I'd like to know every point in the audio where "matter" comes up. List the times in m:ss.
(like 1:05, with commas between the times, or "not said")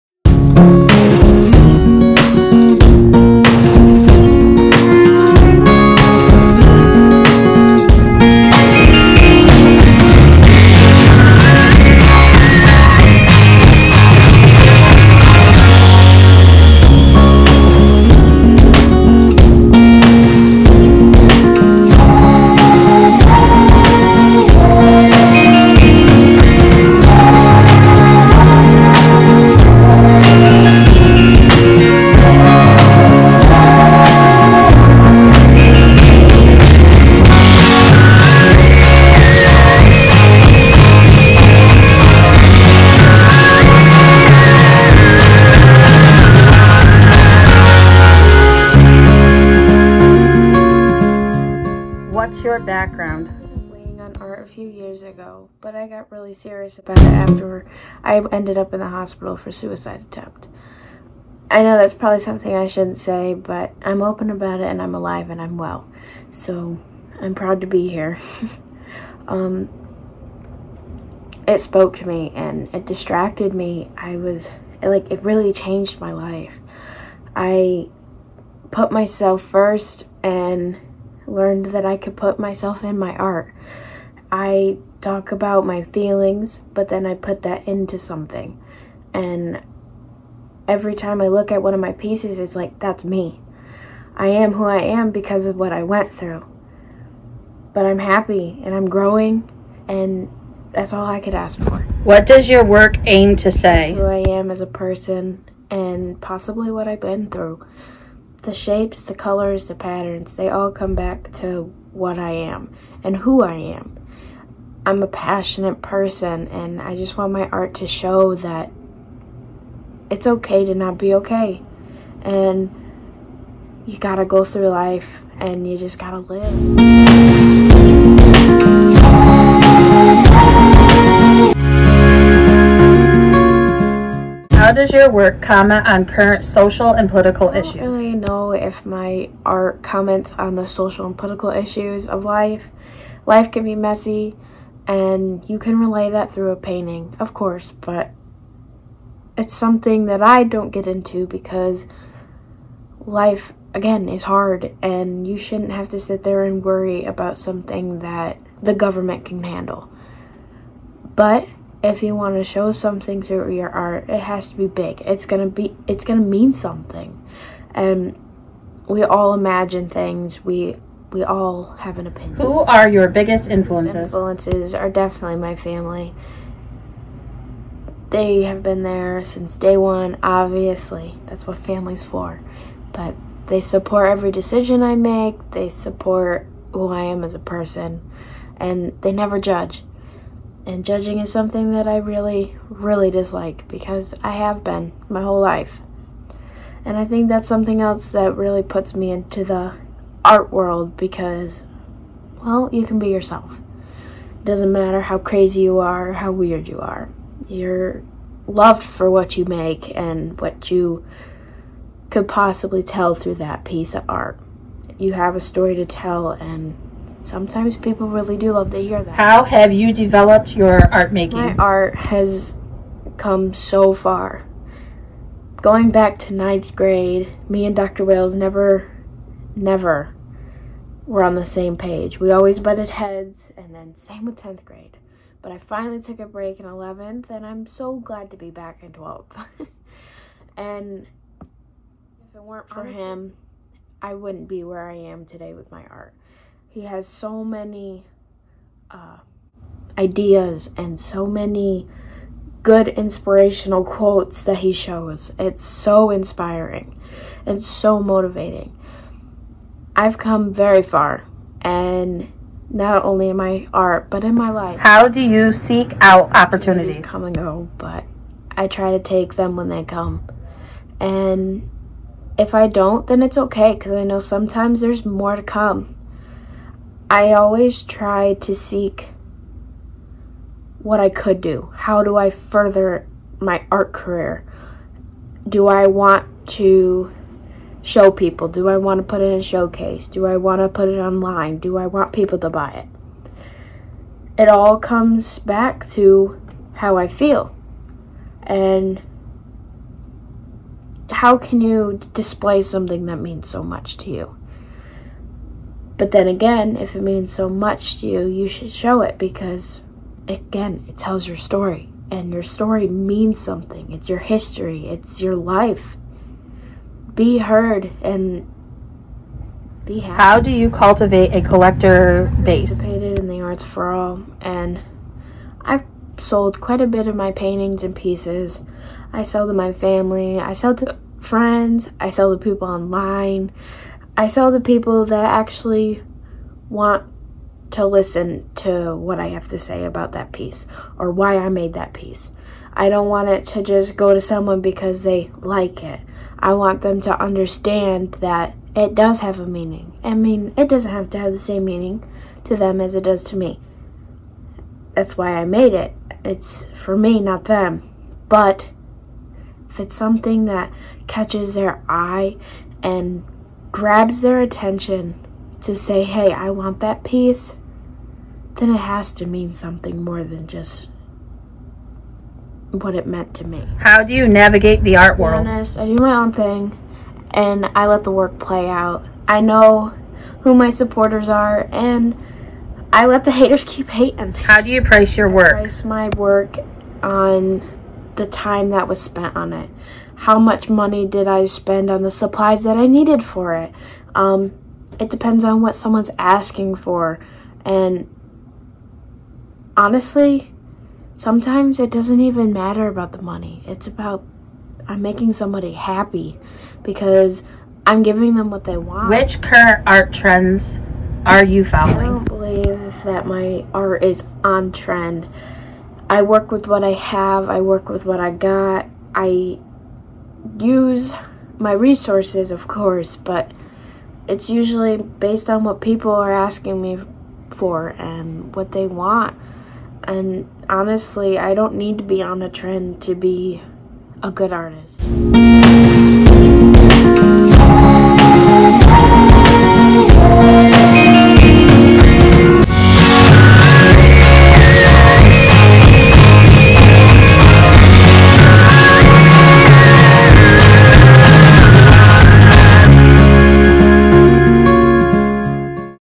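3:24, 6:42.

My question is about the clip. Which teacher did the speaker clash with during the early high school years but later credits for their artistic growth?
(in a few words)
Dr. Wales.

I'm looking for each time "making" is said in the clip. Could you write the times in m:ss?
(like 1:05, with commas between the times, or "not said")
3:41, 6:45.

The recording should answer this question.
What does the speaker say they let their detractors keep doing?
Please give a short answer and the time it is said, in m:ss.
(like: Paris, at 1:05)
Keep hating, at 6:23.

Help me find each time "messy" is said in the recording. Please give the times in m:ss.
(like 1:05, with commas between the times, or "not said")
2:23.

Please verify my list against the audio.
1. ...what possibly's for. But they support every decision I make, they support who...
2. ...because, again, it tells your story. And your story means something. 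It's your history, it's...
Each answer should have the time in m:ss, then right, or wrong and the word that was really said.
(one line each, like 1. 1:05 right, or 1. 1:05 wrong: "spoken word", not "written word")
1. 3:01 wrong: "family", not "possibly"
2. 5:09 right.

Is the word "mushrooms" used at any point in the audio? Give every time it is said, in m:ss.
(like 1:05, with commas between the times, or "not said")
not said.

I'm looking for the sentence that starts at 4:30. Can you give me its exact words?
And if I don't, then it's okay, because I know sometimes there's more to come.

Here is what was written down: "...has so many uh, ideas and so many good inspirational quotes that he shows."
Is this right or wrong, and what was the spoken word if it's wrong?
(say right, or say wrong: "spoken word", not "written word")
right.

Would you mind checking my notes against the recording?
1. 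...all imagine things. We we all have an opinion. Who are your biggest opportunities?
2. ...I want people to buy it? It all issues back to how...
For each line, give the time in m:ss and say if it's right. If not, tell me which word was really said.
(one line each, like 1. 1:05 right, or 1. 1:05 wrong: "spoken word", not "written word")
1. 2:49 wrong: "influences", not "opportunities"
2. 4:51 wrong: "comes", not "issues".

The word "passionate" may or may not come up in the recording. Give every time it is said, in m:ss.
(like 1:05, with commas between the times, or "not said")
1:55.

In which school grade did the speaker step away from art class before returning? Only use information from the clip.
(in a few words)
11th.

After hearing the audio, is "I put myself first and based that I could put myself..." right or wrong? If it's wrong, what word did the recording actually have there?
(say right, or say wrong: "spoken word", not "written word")
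wrong: "learned", not "based".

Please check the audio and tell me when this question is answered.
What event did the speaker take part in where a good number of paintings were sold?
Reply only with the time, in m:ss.
5:23.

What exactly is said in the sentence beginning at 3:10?
And judging is something that I really, really dislike because I have been my whole life.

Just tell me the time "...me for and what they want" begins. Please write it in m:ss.
7:06.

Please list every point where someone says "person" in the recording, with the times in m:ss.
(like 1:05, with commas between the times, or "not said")
1:44, 1:55, 3:07.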